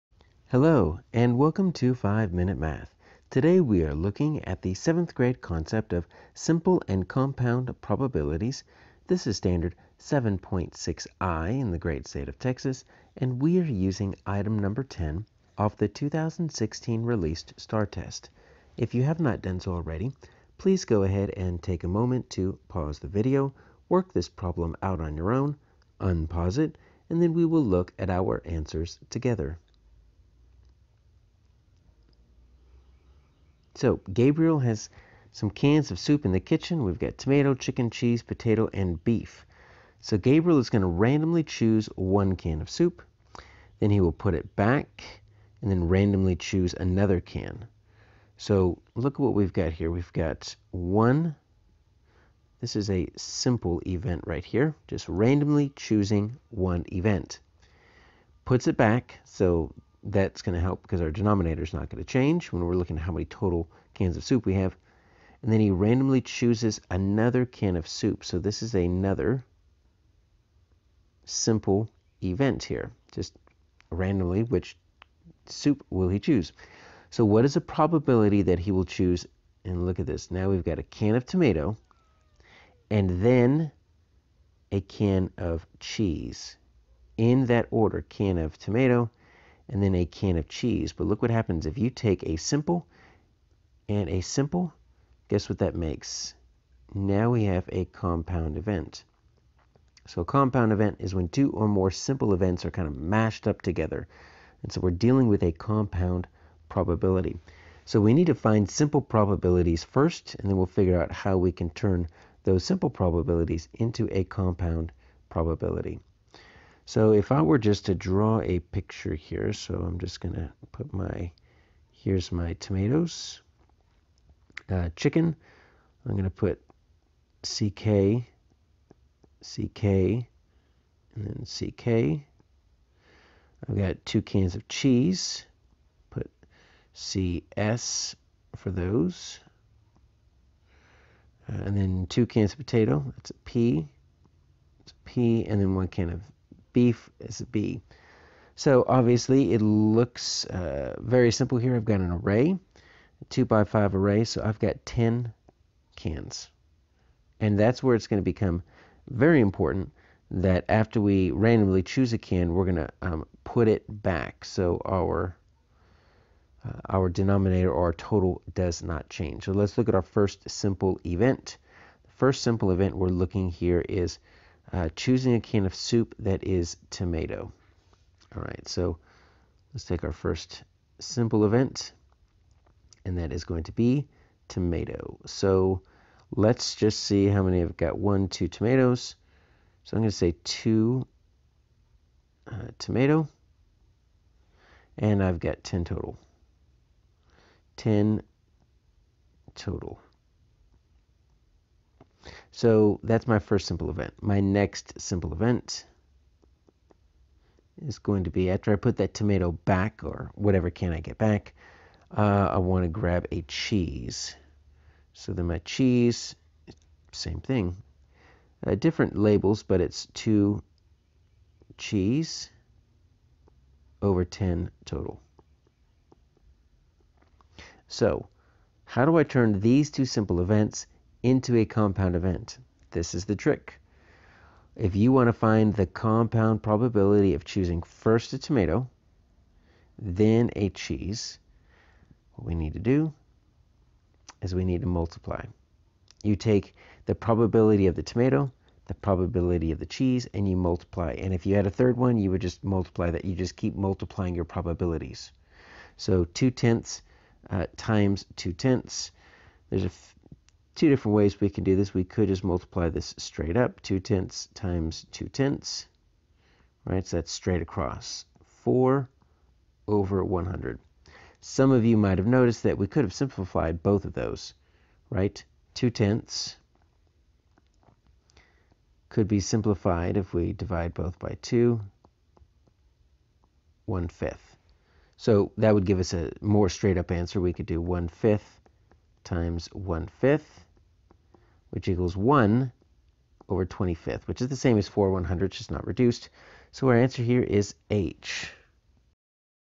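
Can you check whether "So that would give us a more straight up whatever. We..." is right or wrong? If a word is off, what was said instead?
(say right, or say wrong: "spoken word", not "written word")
wrong: "answer", not "whatever".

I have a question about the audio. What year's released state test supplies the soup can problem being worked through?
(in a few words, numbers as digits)
2016.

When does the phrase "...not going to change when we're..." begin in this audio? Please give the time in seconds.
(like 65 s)
61 s.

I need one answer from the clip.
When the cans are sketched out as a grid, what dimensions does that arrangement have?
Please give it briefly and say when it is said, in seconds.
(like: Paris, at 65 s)
2 by 5, at 153 s.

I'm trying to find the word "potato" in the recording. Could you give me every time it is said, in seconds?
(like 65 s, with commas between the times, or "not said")
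38 s, 142 s.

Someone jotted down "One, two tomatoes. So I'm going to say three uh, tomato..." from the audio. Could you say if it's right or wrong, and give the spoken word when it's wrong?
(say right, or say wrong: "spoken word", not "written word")
wrong: "two", not "three".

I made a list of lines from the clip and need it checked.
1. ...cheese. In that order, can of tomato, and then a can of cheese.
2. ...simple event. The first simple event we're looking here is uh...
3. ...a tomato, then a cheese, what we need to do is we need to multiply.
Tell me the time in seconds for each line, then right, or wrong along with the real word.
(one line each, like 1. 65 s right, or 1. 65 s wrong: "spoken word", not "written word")
1. 85 s right
2. 170 s right
3. 238 s right.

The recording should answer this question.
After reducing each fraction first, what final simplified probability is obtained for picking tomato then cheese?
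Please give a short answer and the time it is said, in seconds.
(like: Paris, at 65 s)
1/25, at 292 s.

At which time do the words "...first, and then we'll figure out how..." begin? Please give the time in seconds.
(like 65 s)
109 s.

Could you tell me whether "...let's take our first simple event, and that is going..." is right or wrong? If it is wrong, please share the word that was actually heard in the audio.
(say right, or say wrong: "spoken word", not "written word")
right.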